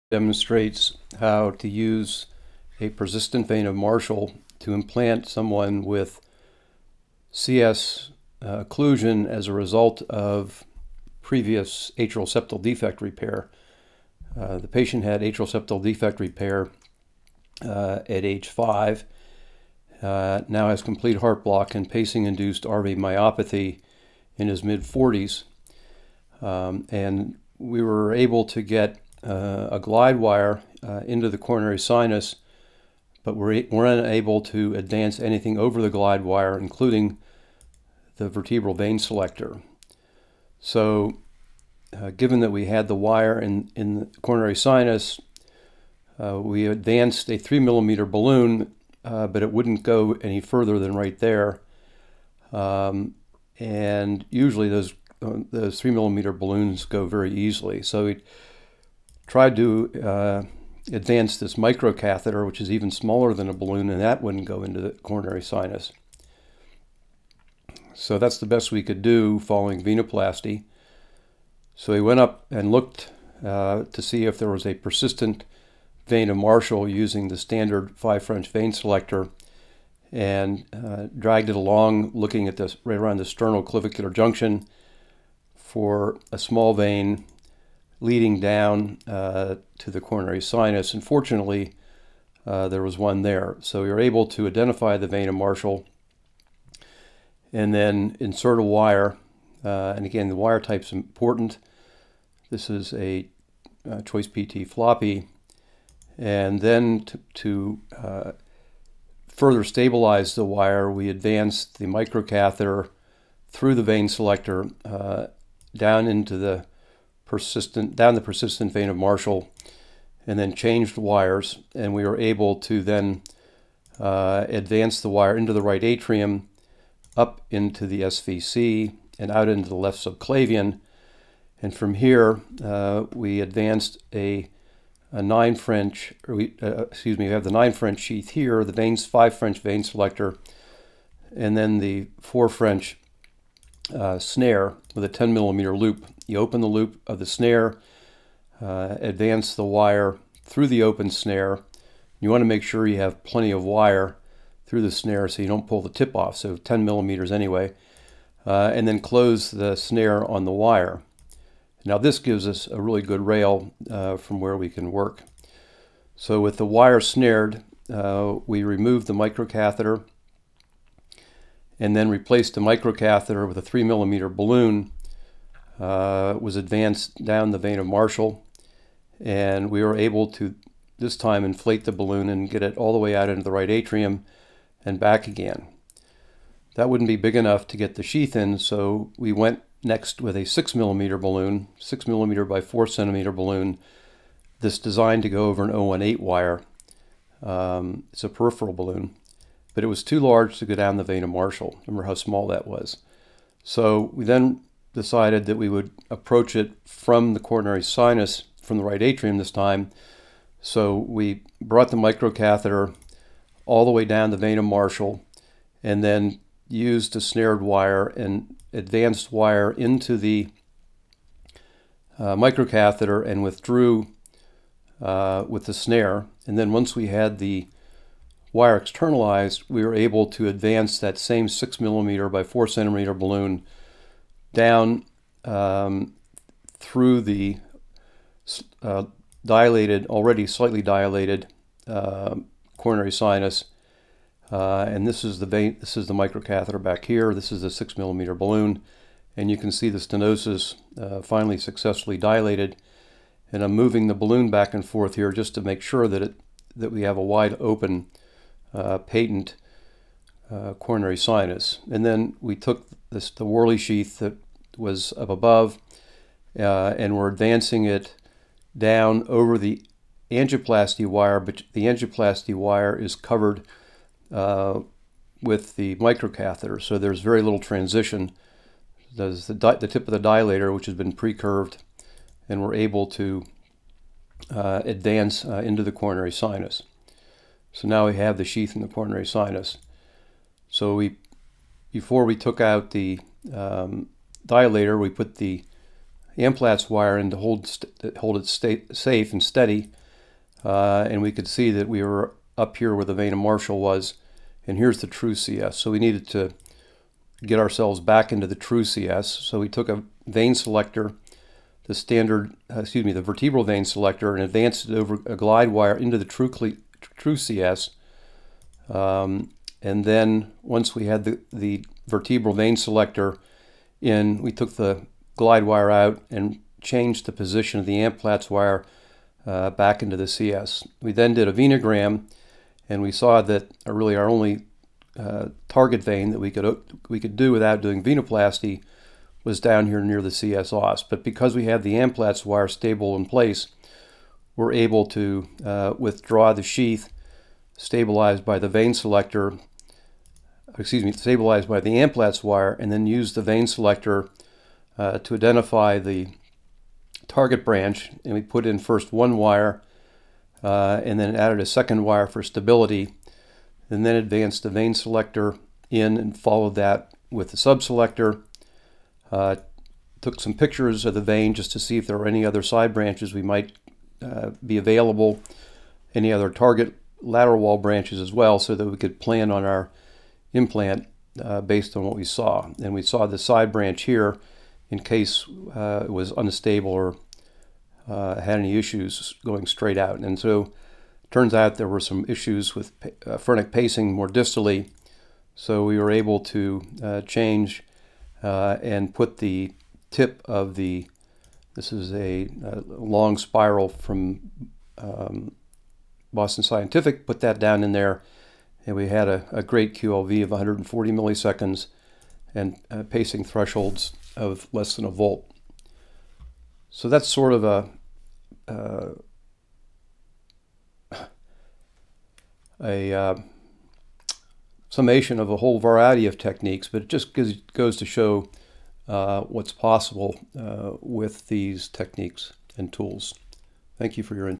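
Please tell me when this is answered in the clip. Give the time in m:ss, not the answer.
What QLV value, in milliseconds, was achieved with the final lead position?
6:50.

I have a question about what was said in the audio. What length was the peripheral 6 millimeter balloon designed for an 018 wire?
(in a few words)
4 centimeters.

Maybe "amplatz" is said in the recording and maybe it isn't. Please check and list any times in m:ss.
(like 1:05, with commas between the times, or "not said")
4:56, 5:27, 5:41, 5:51.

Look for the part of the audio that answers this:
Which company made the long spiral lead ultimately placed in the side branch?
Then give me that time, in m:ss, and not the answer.
6:46.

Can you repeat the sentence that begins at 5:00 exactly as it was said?
Uh, and we could see that we were up here where the vena Marshall was.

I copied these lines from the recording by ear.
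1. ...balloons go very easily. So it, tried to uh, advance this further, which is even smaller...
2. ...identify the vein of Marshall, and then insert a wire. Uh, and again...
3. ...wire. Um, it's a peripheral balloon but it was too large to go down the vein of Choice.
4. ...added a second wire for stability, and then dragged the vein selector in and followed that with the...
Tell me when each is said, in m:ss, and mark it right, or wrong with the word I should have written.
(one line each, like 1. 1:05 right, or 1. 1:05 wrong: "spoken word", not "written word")
1. 0:56 wrong: "microcatheter", not "further"
2. 1:34 right
3. 3:16 wrong: "Marshall", not "Choice"
4. 6:01 wrong: "advanced", not "dragged".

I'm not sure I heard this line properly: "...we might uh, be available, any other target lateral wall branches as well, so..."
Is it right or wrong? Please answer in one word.
right.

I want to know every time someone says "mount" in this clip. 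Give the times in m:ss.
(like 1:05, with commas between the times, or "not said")
not said.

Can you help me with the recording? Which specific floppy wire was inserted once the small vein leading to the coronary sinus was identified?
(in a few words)
Choice PT floppy.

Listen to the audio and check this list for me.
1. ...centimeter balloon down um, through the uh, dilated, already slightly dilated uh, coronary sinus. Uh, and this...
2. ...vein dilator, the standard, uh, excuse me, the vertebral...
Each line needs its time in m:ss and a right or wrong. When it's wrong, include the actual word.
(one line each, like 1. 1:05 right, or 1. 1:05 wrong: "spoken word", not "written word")
1. 3:52 right
2. 5:10 wrong: "selector", not "dilator".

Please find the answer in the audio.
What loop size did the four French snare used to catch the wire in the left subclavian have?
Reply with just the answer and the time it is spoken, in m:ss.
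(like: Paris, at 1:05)
10 millimeters, at 2:25.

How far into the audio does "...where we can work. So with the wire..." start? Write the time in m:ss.
2:44.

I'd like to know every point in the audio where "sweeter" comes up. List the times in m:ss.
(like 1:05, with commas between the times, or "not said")
not said.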